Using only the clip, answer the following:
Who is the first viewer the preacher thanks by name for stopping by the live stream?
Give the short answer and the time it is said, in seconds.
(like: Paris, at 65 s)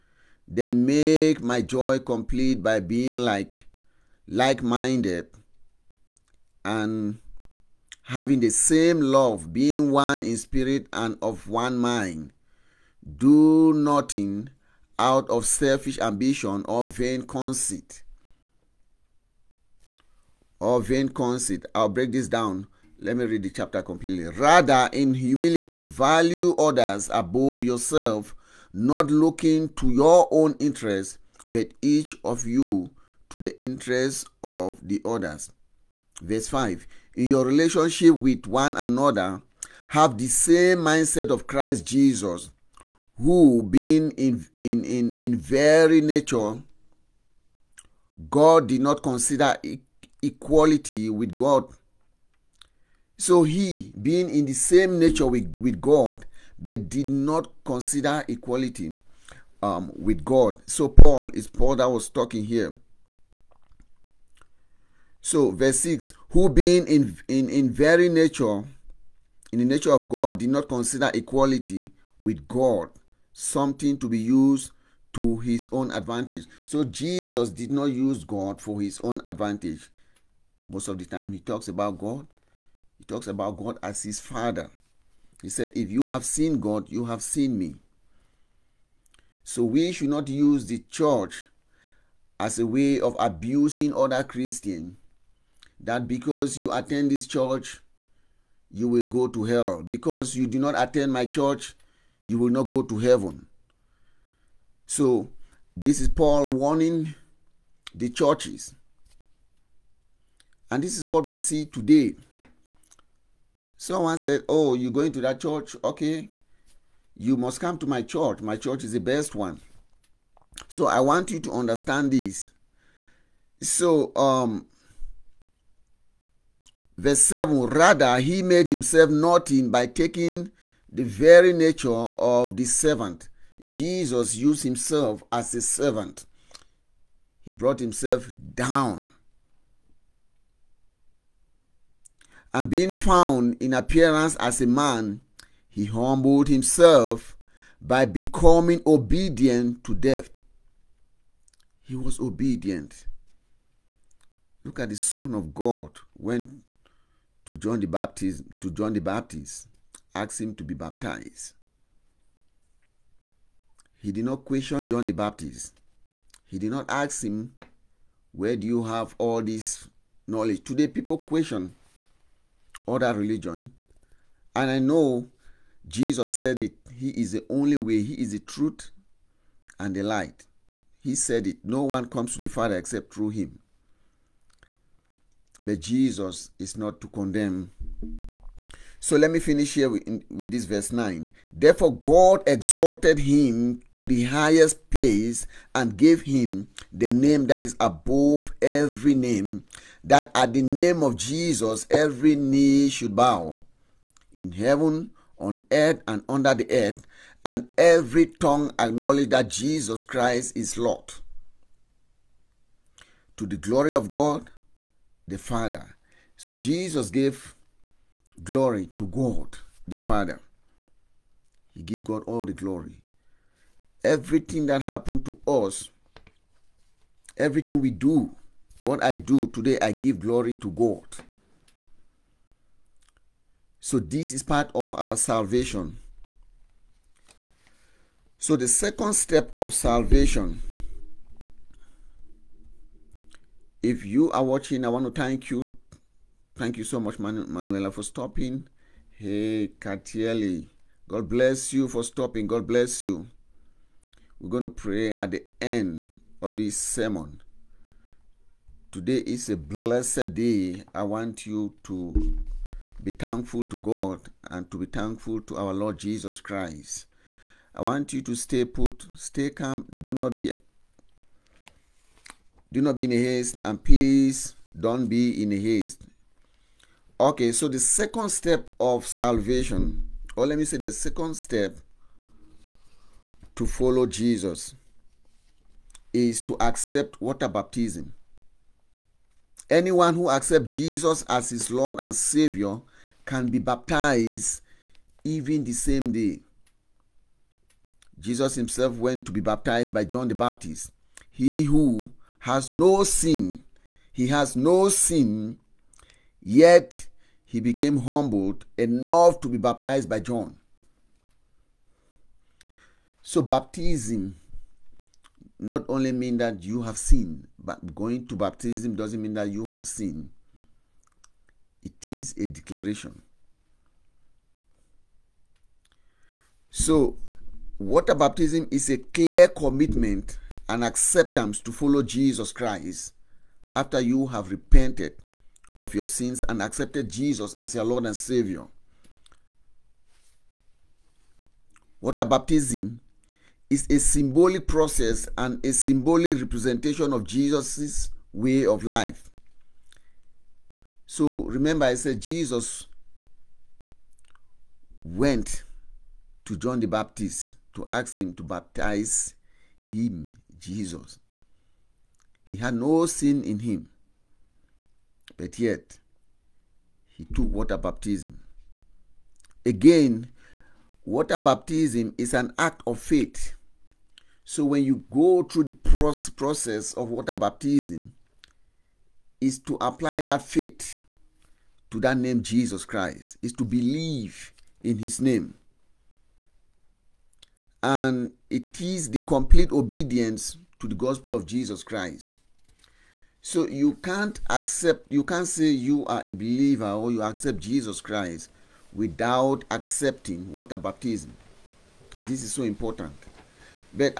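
Manuela, at 247 s.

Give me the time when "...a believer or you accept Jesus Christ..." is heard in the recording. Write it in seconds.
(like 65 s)
396 s.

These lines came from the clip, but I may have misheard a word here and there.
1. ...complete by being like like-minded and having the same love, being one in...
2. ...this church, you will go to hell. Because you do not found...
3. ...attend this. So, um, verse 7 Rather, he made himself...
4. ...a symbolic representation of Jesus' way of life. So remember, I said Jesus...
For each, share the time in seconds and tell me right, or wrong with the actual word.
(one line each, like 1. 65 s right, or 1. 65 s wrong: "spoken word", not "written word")
1. 1 s right
2. 97 s wrong: "attend", not "found"
3. 121 s wrong: "understand", not "attend"
4. 345 s right.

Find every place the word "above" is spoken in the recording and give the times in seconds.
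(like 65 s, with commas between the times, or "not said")
27 s, 197 s.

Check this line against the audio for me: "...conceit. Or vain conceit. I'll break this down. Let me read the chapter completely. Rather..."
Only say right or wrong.
right.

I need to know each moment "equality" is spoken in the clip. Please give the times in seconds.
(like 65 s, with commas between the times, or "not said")
50 s, 58 s, 71 s.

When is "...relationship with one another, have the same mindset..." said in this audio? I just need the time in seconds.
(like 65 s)
37 s.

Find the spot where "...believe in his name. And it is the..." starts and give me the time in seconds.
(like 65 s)
383 s.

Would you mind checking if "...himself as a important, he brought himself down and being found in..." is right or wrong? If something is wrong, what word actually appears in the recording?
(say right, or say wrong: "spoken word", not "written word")
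wrong: "servant", not "important".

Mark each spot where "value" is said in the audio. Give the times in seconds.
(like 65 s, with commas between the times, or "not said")
25 s.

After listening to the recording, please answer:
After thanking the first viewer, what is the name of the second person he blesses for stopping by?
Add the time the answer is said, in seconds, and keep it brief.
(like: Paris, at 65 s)
Katieli, at 249 s.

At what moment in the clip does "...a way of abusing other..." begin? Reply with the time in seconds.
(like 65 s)
92 s.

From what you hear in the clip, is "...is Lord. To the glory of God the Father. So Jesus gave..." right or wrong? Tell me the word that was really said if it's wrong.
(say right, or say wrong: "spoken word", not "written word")
right.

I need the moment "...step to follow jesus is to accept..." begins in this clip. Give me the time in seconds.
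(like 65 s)
281 s.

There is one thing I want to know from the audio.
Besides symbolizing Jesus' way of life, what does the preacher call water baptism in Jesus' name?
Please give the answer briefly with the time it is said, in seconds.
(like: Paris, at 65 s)
an act of faith, at 372 s.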